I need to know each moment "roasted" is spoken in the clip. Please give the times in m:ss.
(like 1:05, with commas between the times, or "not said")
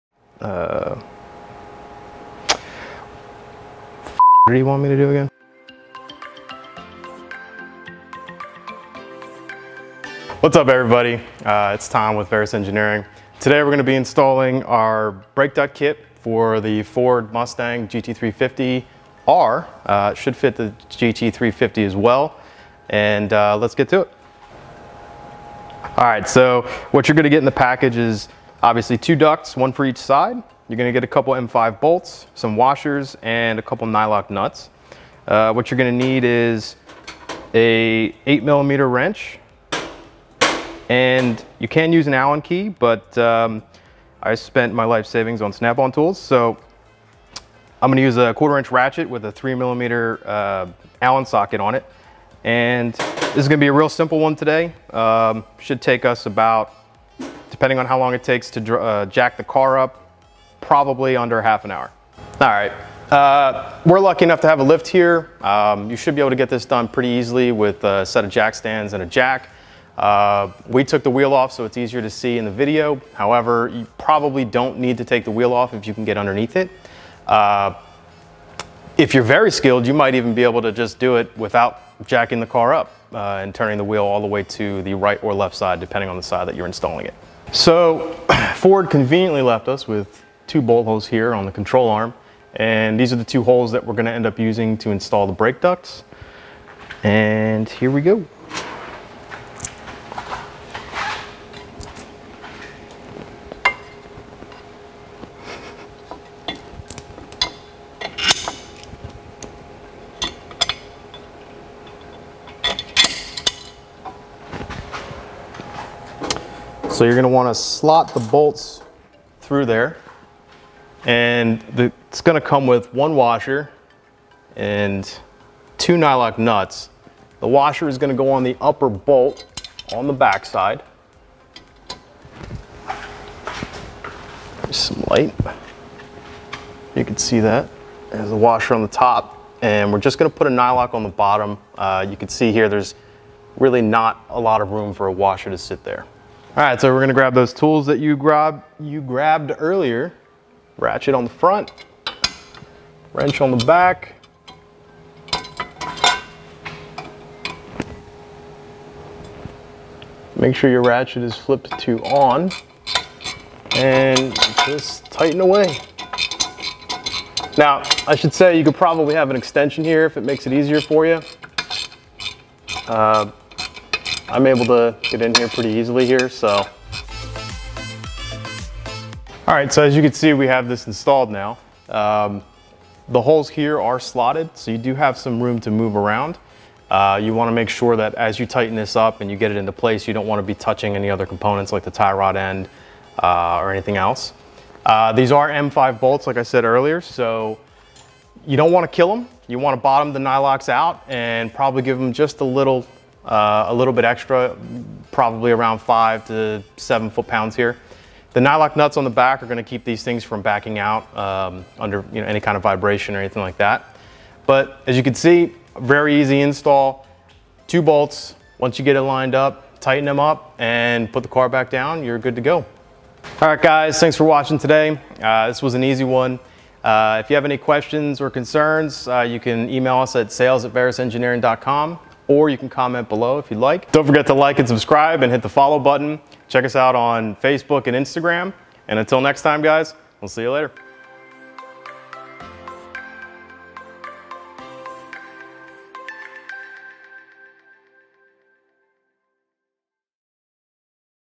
not said.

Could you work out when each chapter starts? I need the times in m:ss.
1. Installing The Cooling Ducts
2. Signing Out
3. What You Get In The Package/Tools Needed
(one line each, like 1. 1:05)
1. 1:37
2. 3:43
3. 0:24.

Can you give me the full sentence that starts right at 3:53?
Don't forget to like and subscribe and hit the follow button.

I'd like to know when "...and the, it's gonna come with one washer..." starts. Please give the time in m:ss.
2:01.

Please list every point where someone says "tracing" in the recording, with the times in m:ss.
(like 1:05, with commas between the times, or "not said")
not said.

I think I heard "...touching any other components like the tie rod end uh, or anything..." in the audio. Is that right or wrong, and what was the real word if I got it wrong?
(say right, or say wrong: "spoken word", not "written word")
right.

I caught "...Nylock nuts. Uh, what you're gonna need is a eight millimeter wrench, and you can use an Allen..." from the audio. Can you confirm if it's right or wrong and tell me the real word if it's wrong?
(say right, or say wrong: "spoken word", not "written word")
right.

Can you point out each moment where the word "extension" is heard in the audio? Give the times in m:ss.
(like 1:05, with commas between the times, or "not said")
2:49.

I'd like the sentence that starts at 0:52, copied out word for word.
And this is gonna be a real simple one today.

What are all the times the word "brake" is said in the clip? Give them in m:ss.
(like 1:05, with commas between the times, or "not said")
0:15, 1:35.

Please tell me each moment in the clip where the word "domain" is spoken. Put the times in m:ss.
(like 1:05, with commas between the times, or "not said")
not said.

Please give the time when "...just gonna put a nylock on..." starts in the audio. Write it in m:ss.
2:19.